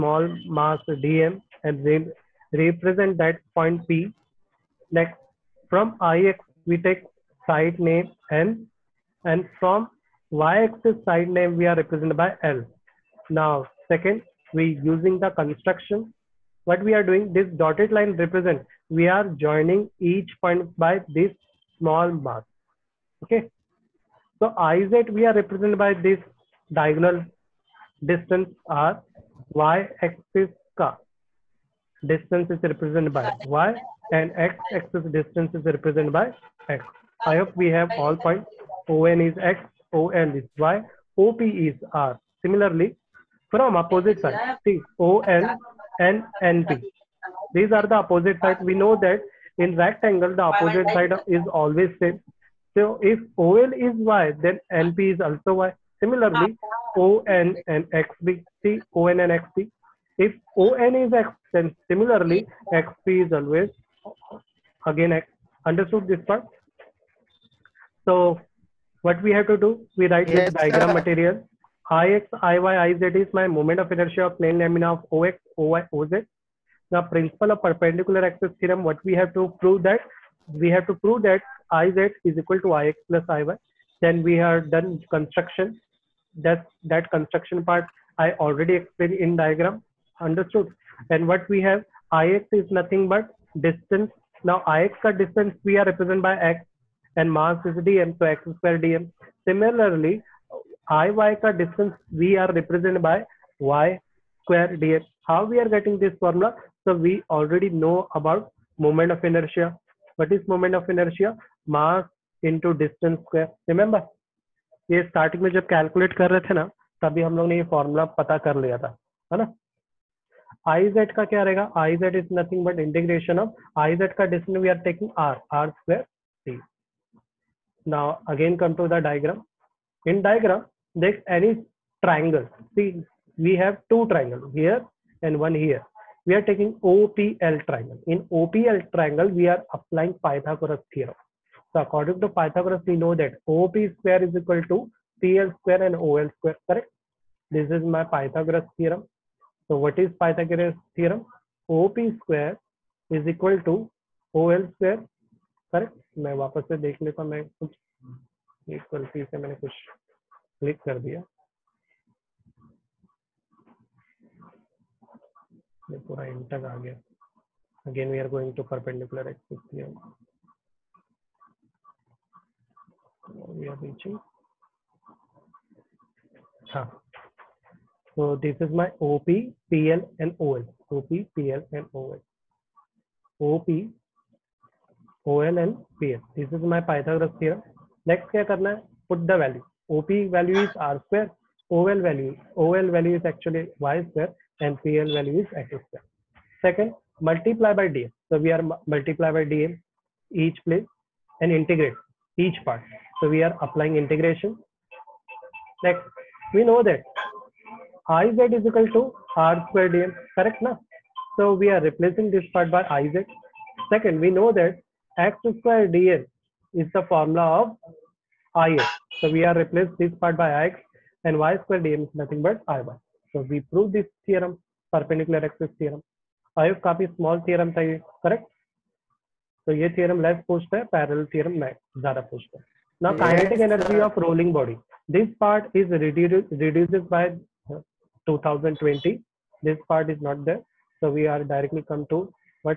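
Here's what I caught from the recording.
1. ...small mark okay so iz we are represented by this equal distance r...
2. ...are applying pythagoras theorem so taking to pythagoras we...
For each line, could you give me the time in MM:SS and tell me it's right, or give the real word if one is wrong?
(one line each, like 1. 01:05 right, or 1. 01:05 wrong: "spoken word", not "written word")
1. 00:21 wrong: "diagonal", not "equal"
2. 02:19 wrong: "according", not "taking".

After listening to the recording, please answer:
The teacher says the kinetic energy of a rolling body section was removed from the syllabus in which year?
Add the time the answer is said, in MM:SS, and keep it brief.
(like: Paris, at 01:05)
2020, at 03:58.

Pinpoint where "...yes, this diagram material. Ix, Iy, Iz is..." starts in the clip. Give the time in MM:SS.
01:10.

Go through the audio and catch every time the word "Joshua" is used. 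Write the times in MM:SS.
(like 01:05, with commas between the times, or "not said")
not said.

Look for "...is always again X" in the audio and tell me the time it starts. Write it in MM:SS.
01:03.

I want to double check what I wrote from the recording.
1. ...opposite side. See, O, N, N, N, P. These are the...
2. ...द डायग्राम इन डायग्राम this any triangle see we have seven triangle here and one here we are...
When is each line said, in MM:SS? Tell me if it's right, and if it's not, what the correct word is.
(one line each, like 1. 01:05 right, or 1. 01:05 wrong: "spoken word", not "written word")
1. 00:43 right
2. 02:08 wrong: "two", not "seven".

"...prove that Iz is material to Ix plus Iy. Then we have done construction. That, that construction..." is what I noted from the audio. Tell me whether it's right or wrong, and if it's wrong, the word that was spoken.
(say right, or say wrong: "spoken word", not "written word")
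wrong: "equal", not "material".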